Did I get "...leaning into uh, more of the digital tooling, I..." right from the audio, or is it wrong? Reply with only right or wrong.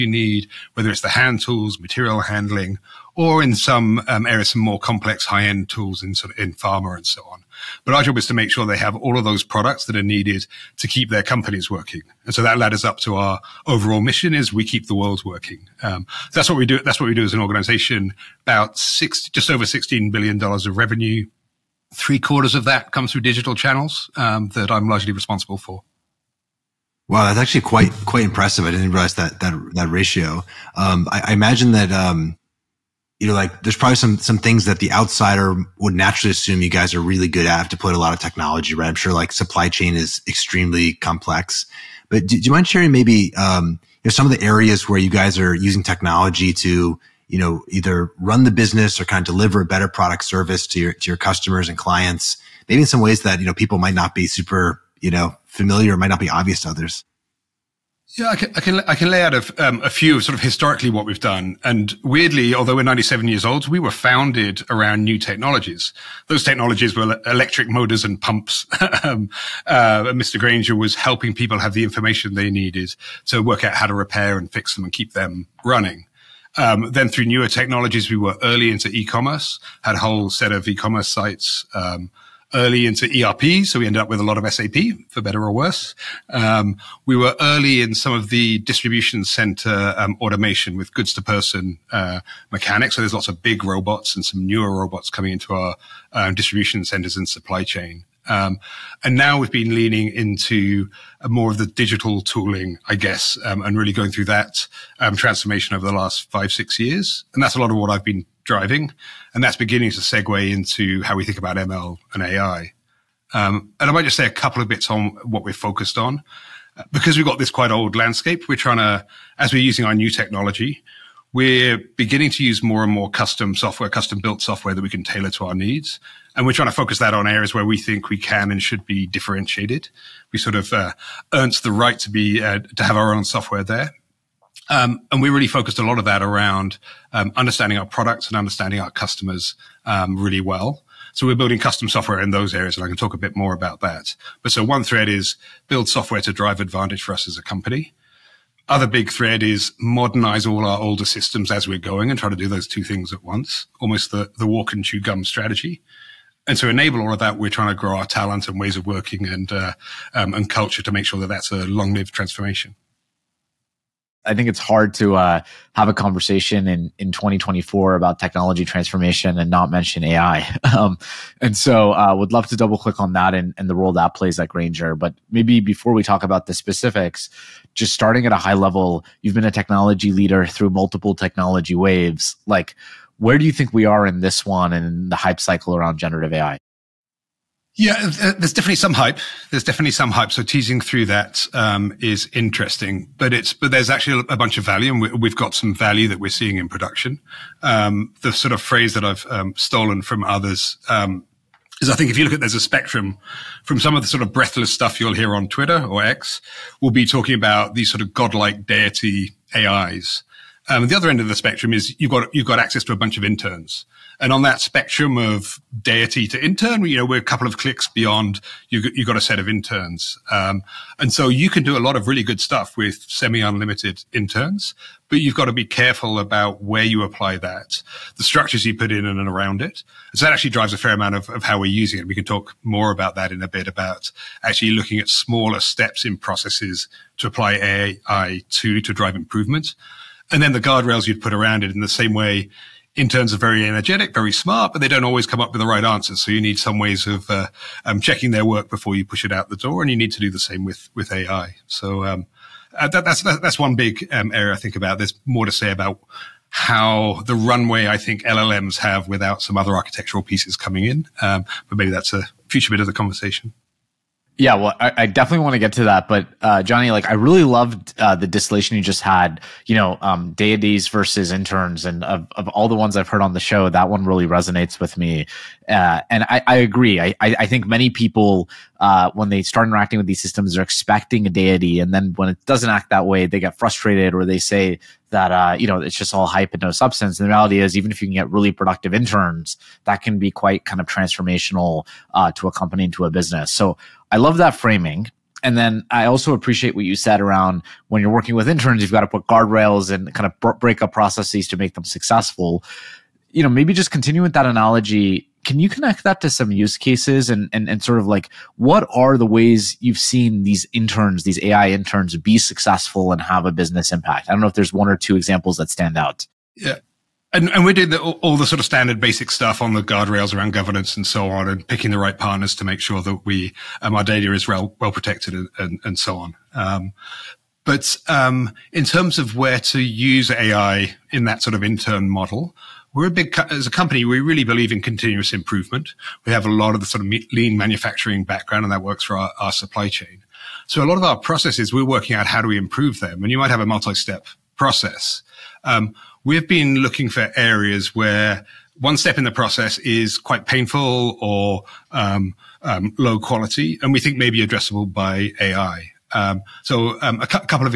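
right.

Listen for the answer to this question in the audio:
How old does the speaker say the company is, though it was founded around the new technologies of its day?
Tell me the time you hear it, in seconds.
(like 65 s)
62 s.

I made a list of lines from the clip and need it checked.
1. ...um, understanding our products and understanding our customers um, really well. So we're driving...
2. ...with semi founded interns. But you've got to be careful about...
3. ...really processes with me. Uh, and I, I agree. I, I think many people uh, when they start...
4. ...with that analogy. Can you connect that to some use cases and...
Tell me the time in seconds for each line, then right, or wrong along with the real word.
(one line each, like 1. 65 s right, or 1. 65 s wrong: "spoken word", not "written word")
1. 137 s wrong: "building", not "driving"
2. 222 s wrong: "unlimited", not "founded"
3. 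274 s wrong: "resonates", not "processes"
4. 304 s right.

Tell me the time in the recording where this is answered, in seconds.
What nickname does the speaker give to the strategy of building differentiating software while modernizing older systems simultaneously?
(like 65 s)
154 s.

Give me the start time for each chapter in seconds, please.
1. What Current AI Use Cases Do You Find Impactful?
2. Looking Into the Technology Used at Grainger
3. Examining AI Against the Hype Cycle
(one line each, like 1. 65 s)
1. 264 s
2. 26 s
3. 164 s.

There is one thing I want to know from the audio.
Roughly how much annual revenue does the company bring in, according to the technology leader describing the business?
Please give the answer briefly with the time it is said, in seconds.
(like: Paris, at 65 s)
just over $16 billion, at 19 s.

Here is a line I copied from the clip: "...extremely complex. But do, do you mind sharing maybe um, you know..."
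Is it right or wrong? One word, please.
right.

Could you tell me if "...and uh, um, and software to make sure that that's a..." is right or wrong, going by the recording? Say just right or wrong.
wrong.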